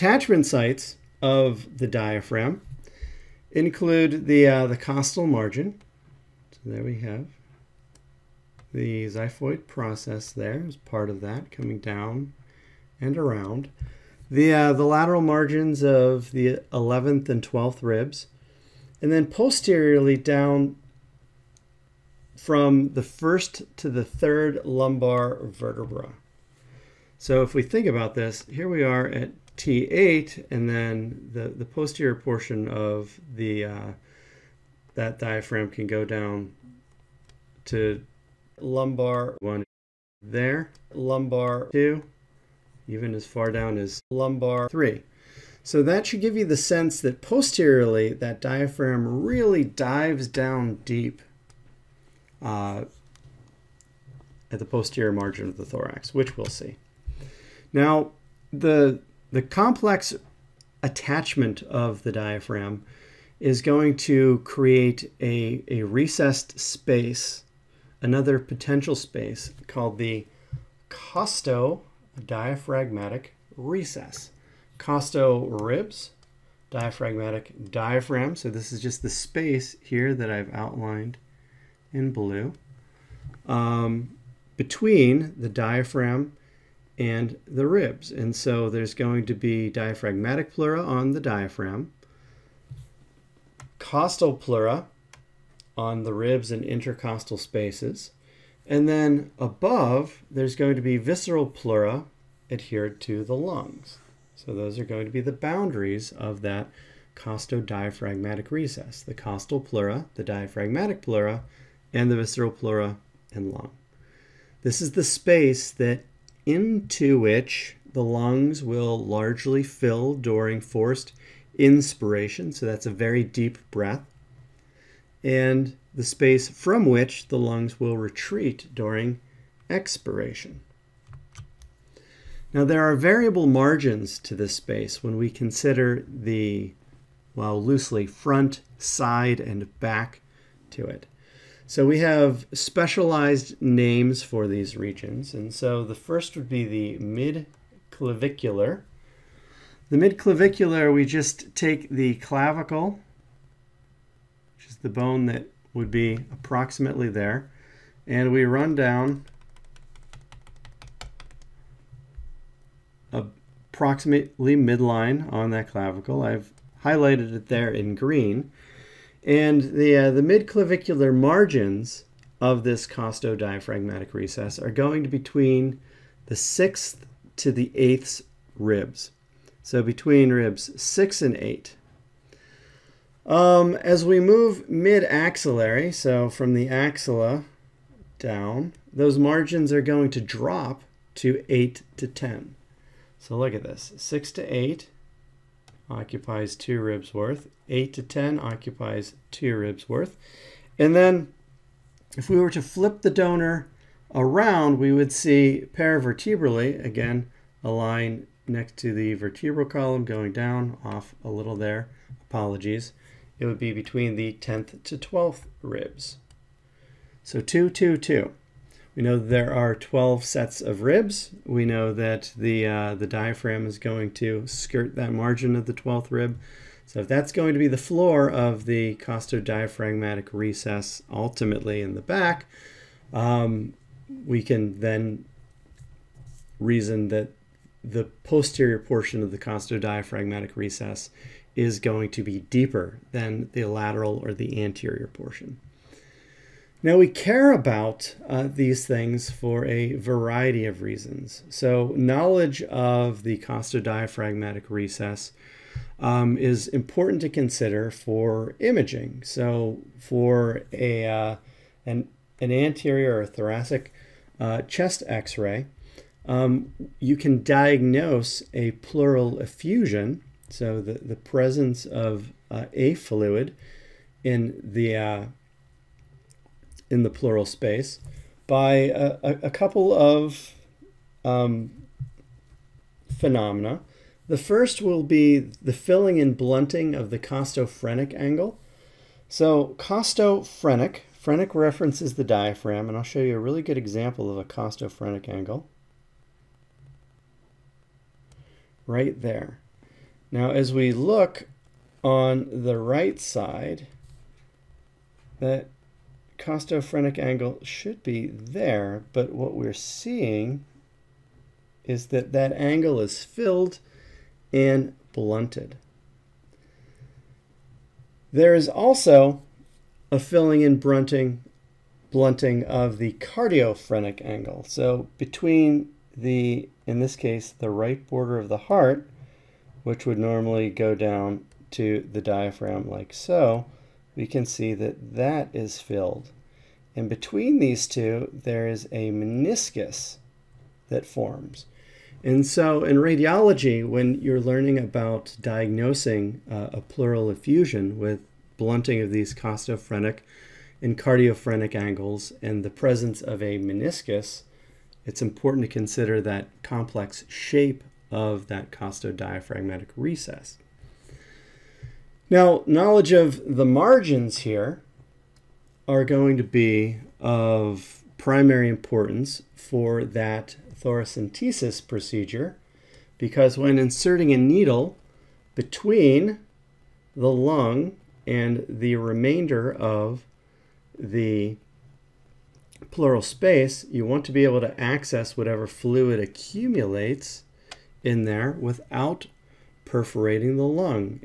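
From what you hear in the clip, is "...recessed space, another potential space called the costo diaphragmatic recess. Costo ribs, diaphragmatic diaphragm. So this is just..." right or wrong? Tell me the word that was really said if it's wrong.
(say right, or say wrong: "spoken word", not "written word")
right.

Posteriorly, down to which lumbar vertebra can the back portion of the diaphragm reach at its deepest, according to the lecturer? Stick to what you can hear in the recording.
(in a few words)
Lumbar 3.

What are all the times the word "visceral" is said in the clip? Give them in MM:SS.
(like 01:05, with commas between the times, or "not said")
01:40, 01:52.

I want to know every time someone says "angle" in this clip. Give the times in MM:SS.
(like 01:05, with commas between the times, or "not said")
04:48, 04:55, 05:07, 05:12, 05:24, 05:51.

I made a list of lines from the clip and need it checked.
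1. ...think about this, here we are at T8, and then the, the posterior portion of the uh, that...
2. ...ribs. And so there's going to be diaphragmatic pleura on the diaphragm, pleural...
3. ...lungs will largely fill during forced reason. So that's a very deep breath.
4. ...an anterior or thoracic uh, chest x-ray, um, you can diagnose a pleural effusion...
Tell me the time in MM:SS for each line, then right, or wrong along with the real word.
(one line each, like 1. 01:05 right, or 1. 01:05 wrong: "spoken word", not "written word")
1. 00:27 right
2. 01:27 wrong: "costal", not "pleural"
3. 01:58 wrong: "inspiration", not "reason"
4. 04:22 right.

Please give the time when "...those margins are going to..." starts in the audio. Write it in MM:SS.
03:08.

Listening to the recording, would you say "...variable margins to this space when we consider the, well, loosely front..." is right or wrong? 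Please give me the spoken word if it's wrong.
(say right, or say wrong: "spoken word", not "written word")
right.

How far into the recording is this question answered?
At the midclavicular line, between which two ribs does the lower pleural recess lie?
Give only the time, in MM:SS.
02:59.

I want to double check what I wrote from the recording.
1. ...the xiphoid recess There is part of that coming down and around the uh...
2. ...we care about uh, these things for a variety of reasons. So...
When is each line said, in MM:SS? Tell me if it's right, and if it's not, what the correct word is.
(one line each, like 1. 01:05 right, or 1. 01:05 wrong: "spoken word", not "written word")
1. 00:08 wrong: "process", not "recess"
2. 04:06 right.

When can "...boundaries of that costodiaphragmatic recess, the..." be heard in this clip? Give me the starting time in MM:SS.
01:45.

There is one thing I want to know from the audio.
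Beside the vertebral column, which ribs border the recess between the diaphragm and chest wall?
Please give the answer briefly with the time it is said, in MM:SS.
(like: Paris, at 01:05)
10th to 12th, at 03:34.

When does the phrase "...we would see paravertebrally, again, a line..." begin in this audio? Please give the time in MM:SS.
03:24.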